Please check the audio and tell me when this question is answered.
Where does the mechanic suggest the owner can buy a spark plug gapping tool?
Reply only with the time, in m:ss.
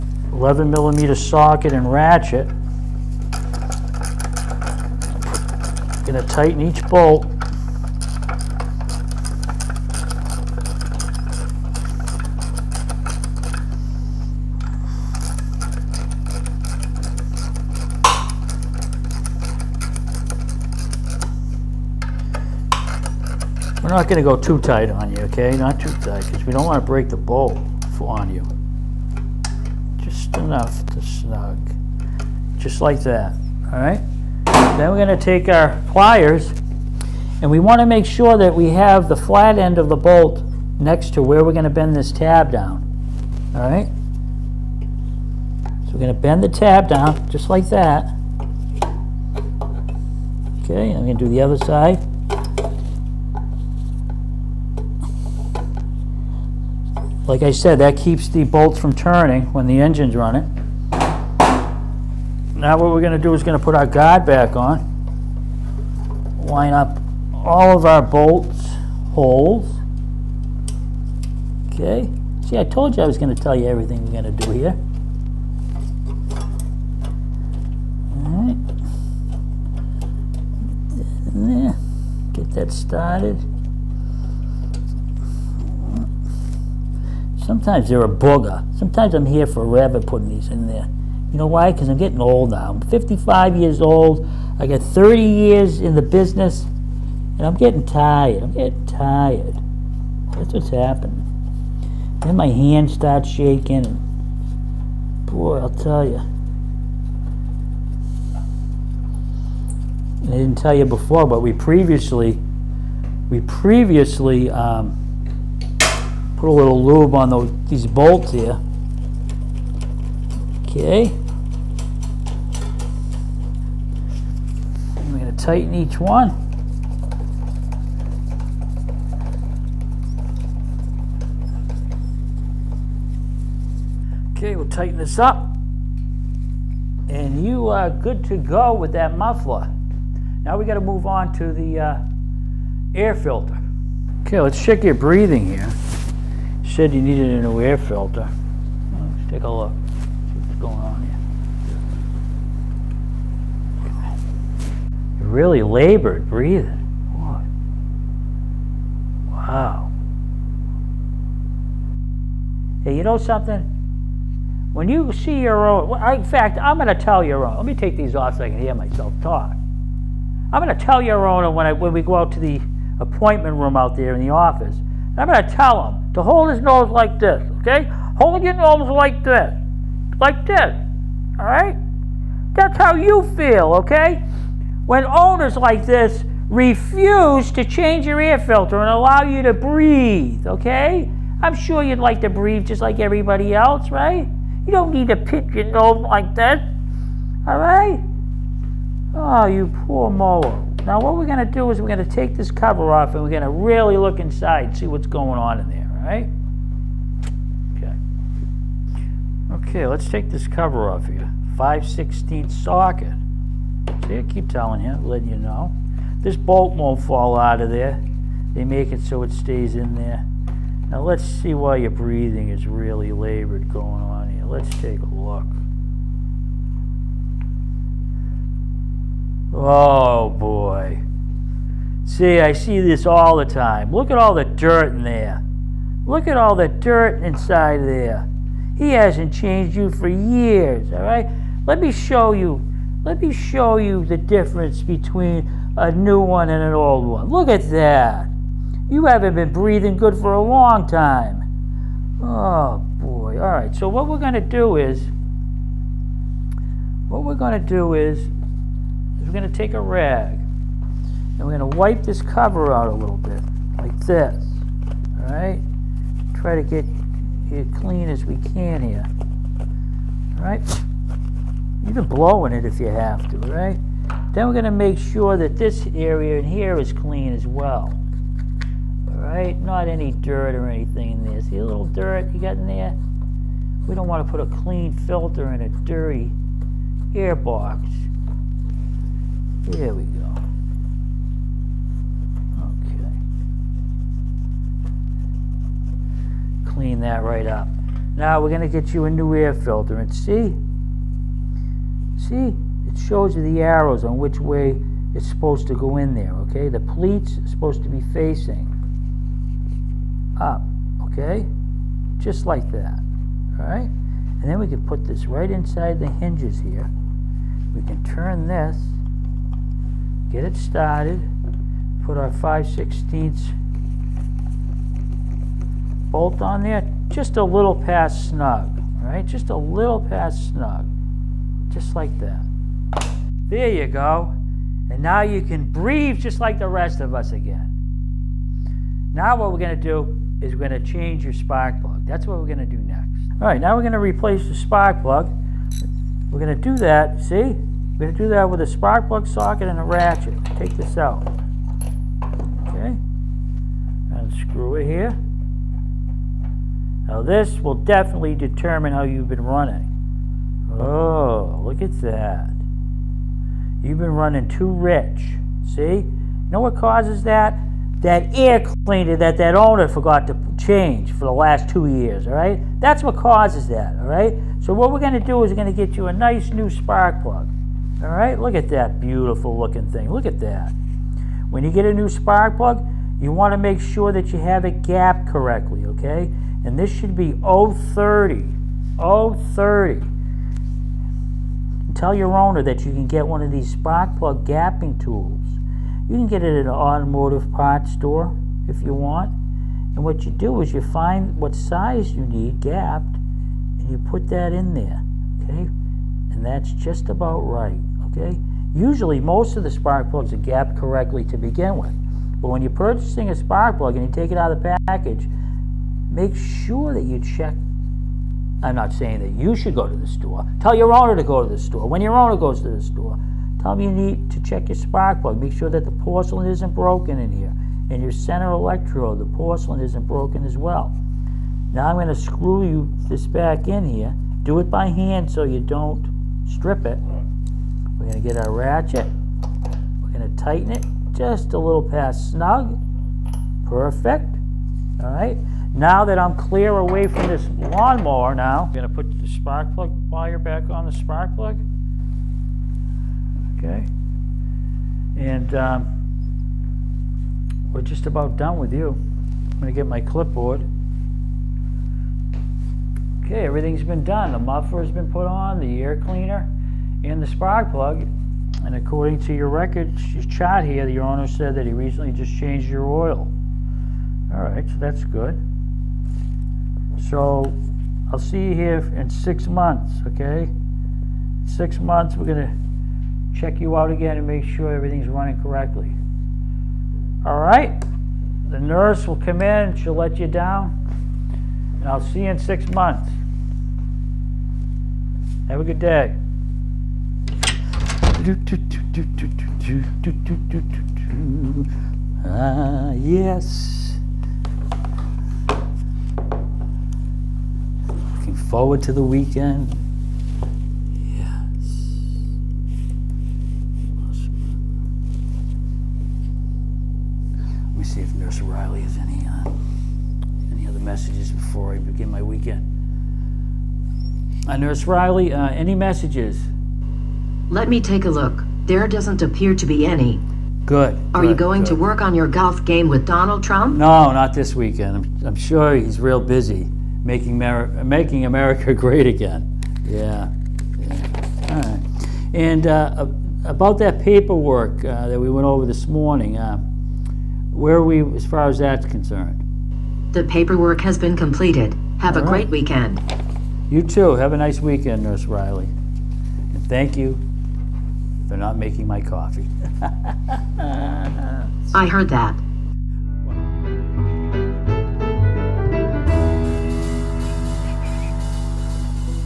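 6:36.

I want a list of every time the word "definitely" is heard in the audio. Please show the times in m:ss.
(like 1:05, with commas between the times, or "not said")
5:57.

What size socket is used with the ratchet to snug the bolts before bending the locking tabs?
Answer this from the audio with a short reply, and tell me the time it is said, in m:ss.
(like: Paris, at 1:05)
11 millimeter, at 0:00.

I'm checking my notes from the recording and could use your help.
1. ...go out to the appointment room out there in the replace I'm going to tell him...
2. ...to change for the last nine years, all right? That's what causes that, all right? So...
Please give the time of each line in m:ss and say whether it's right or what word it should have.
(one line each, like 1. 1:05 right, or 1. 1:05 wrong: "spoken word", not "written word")
1. 2:52 wrong: "office", not "replace"
2. 6:10 wrong: "two", not "nine".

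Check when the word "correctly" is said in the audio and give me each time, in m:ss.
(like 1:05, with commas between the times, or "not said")
6:25, 6:50, 8:05.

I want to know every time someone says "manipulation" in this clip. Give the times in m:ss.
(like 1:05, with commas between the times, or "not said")
not said.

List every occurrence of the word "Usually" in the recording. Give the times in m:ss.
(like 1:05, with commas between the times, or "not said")
6:48.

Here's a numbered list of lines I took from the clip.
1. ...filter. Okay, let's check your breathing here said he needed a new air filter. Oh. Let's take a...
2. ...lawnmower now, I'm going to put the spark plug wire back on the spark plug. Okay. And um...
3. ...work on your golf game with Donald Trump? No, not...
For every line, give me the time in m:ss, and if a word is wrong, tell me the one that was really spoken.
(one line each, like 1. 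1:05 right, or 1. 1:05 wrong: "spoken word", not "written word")
1. 2:23 right
2. 7:27 right
3. 8:51 right.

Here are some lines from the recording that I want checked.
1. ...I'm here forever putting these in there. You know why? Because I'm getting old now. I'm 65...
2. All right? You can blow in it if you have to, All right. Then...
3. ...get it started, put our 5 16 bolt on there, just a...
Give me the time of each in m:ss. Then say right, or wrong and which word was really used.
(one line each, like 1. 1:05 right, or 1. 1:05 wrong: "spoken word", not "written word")
1. 1:29 wrong: "55", not "65"
2. 4:29 right
3. 5:20 right.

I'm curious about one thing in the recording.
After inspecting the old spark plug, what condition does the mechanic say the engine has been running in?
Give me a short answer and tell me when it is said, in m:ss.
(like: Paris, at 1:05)
Too rich, at 6:04.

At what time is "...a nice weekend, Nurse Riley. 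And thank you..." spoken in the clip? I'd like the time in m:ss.
9:14.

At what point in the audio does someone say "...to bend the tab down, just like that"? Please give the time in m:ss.
0:46.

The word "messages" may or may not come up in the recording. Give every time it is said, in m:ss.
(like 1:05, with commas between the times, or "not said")
8:40, 8:45.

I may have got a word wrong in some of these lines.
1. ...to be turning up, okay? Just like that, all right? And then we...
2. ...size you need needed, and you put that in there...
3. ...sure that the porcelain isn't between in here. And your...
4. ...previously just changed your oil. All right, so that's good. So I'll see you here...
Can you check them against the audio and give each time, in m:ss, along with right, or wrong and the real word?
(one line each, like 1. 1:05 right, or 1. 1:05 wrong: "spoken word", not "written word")
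1. 5:07 wrong: "facing", not "turning"
2. 6:41 wrong: "gapped", not "needed"
3. 7:05 wrong: "broken", not "between"
4. 7:51 wrong: "recently", not "previously".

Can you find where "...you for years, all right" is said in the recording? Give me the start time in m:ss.
3:59.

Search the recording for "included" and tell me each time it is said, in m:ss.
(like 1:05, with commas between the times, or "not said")
not said.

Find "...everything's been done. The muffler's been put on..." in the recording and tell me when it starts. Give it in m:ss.
7:43.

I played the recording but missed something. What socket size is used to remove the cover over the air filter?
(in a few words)
5/16.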